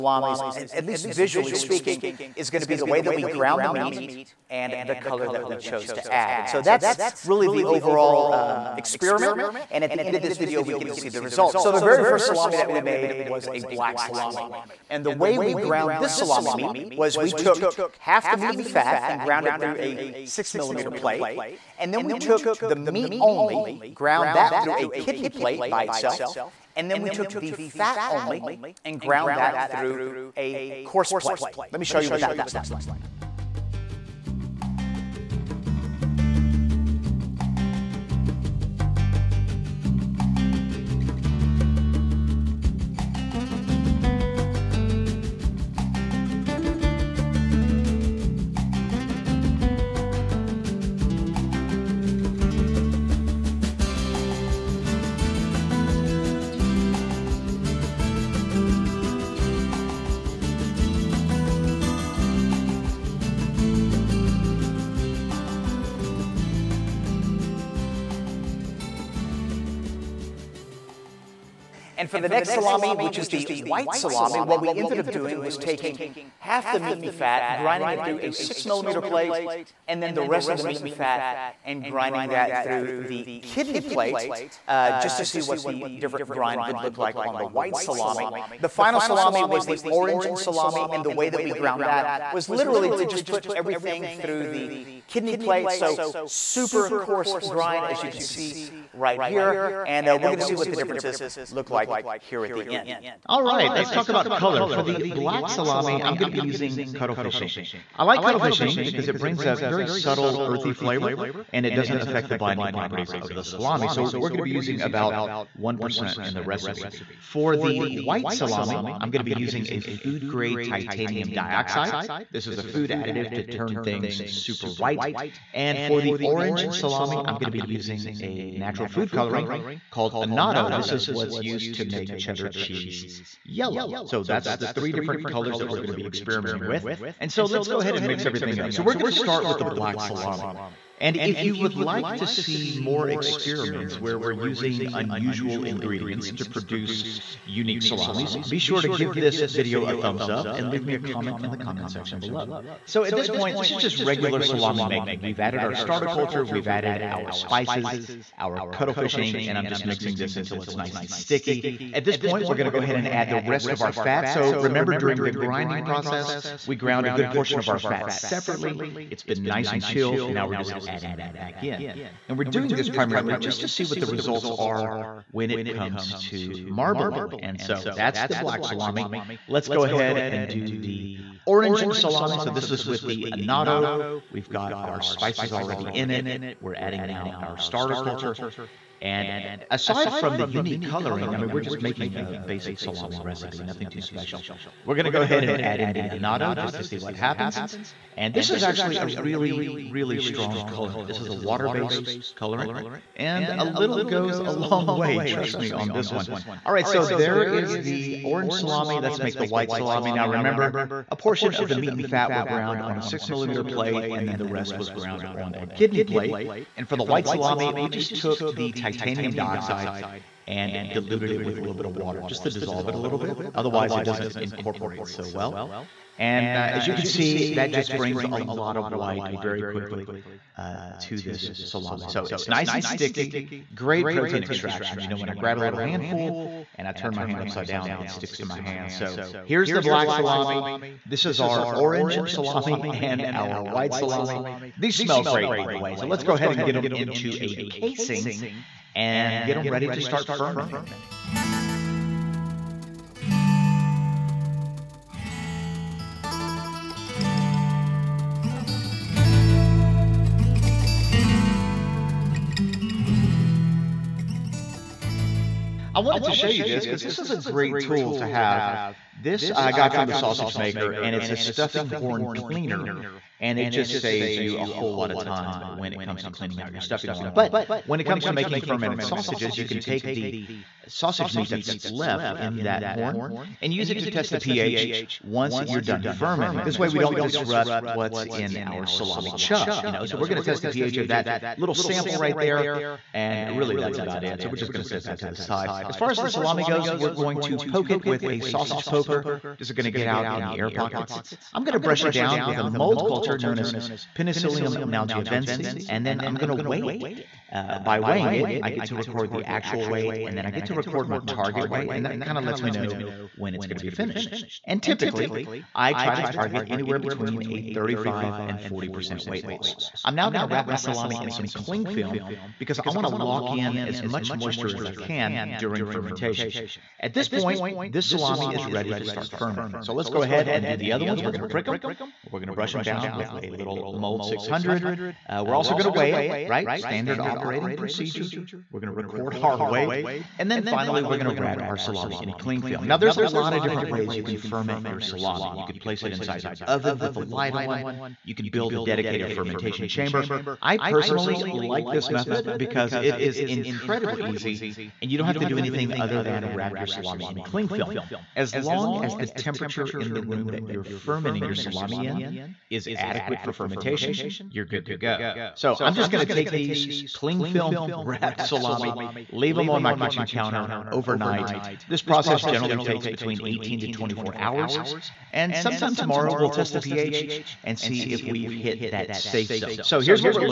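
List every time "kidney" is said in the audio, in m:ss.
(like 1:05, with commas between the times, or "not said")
0:24, 1:23, 1:35, 3:35.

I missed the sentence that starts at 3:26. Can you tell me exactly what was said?
All right, so there is the orange salami.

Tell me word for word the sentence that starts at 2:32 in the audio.
So at this point, this is just regular salami making.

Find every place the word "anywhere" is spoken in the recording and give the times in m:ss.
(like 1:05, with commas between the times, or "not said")
5:16.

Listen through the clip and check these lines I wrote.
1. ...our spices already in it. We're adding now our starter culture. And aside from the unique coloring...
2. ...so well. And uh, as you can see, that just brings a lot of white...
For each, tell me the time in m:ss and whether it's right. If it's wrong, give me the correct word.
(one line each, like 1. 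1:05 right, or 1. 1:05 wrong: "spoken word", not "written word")
1. 3:04 right
2. 3:45 right.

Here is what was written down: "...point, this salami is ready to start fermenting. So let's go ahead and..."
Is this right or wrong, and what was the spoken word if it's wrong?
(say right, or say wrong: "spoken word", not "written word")
right.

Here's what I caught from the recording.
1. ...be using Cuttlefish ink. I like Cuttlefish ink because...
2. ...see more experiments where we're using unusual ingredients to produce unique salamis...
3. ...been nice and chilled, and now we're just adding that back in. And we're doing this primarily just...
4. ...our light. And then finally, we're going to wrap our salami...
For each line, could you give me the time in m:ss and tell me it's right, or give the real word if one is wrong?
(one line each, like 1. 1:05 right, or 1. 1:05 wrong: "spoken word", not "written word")
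1. 1:46 right
2. 2:22 right
3. 2:49 right
4. 5:39 wrong: "weight", not "light".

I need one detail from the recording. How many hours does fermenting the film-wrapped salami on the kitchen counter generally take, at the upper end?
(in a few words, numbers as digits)
24 hours.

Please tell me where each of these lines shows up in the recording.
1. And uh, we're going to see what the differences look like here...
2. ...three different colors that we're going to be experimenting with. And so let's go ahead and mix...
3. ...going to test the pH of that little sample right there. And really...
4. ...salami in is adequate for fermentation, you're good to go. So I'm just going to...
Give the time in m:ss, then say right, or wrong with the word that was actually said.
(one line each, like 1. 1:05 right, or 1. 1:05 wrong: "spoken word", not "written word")
1. 1:39 right
2. 2:14 right
3. 4:50 right
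4. 6:01 right.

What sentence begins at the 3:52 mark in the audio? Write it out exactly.
So it's nice and sticky, great protein extraction.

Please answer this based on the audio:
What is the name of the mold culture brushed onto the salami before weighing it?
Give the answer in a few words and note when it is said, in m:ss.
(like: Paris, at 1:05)
Penicillium nalgiovense, at 5:04.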